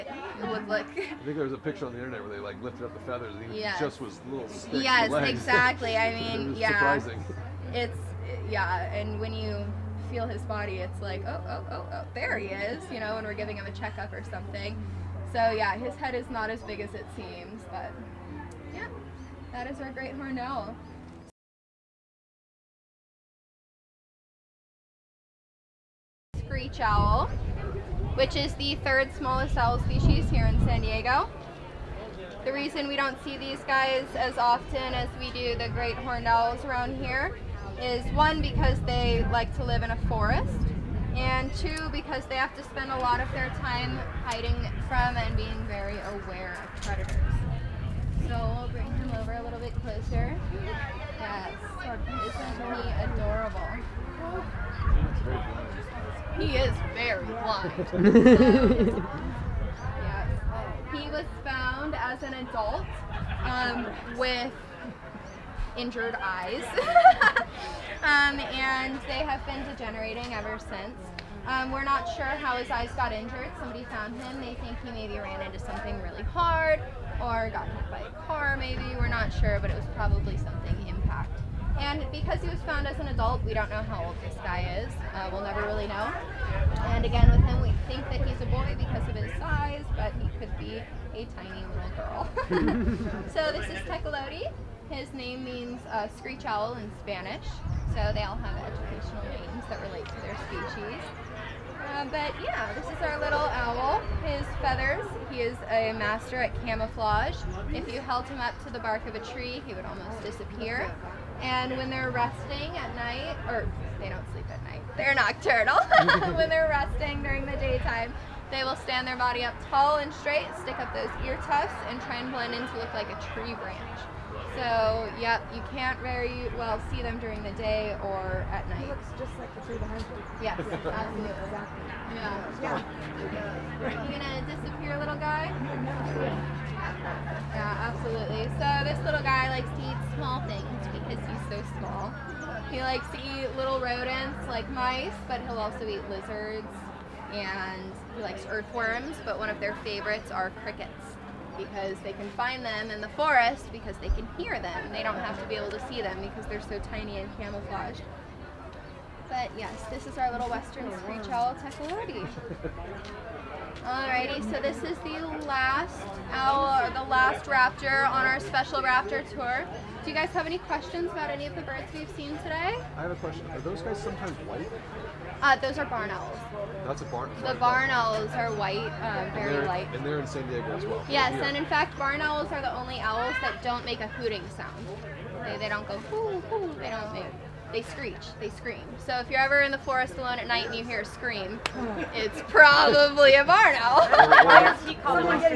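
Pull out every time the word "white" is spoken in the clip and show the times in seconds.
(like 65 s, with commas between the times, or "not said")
174 s, 178 s.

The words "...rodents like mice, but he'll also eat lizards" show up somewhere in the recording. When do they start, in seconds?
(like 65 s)
143 s.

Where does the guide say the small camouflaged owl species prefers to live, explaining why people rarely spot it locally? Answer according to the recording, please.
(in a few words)
a forest.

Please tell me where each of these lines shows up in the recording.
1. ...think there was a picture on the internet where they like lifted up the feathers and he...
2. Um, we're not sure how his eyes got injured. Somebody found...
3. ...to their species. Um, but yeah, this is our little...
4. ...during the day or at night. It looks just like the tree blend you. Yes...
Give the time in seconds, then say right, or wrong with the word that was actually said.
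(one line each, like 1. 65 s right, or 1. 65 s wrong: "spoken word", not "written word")
1. 1 s right
2. 71 s right
3. 100 s right
4. 127 s wrong: "behind", not "blend".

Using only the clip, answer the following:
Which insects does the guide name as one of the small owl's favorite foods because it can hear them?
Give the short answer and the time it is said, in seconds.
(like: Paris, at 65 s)
crickets, at 150 s.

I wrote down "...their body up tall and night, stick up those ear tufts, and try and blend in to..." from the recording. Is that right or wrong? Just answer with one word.
wrong.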